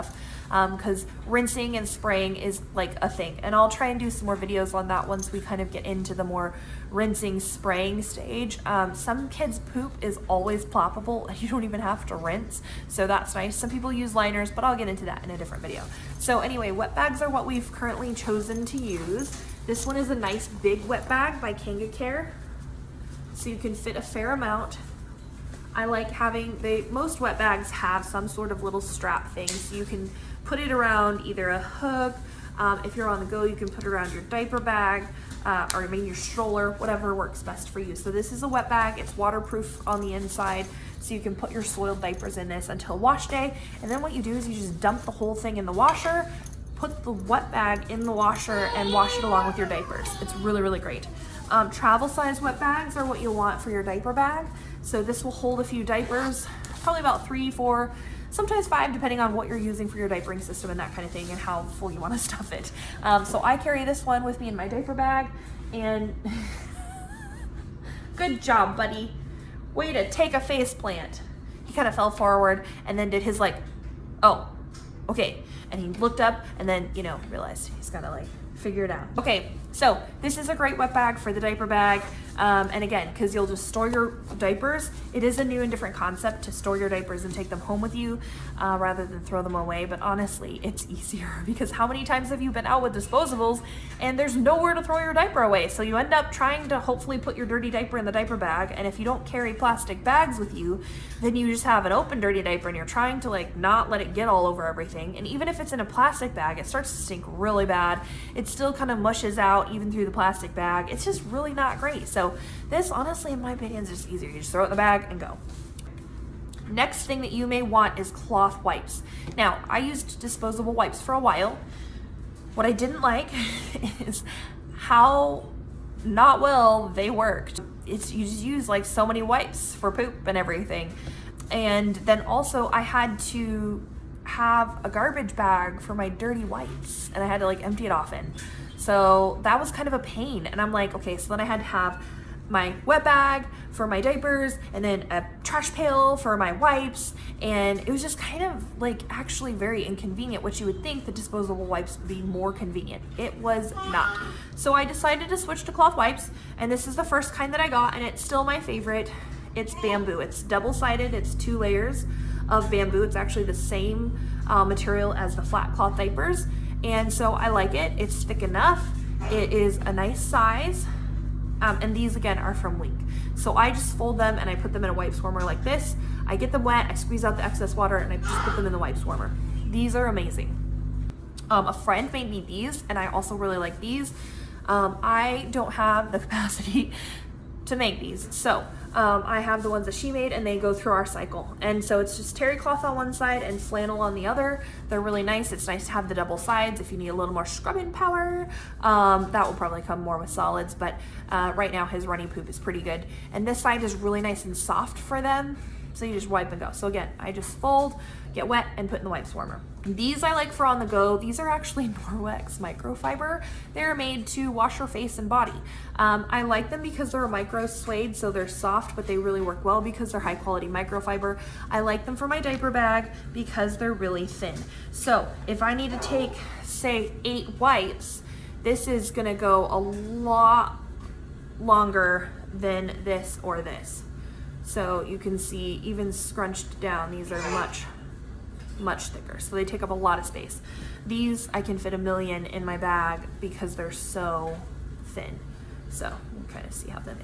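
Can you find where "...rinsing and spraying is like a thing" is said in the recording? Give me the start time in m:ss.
0:01.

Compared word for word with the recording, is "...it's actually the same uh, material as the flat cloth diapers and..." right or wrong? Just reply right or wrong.
right.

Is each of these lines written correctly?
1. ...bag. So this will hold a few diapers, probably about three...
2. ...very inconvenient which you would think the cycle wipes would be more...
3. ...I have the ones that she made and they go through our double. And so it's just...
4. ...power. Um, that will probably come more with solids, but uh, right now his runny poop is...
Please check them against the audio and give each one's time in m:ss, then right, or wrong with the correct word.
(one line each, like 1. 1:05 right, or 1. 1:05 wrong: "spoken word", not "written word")
1. 0:54 right
2. 2:29 wrong: "disposable", not "cycle"
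3. 3:09 wrong: "cycle", not "double"
4. 3:17 right.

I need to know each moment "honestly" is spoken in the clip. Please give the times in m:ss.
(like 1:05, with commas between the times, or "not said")
1:30, 1:52.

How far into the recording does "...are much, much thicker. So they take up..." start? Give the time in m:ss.
3:57.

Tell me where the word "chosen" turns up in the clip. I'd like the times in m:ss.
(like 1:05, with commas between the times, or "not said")
0:18.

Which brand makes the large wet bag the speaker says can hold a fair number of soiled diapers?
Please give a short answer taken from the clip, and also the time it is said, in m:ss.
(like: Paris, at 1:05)
KangaCare, at 0:21.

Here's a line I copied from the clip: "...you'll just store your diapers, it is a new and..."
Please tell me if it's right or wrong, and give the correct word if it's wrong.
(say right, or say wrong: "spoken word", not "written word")
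right.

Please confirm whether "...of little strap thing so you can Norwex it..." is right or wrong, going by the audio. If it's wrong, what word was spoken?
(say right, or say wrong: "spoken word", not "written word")
wrong: "Put", not "Norwex".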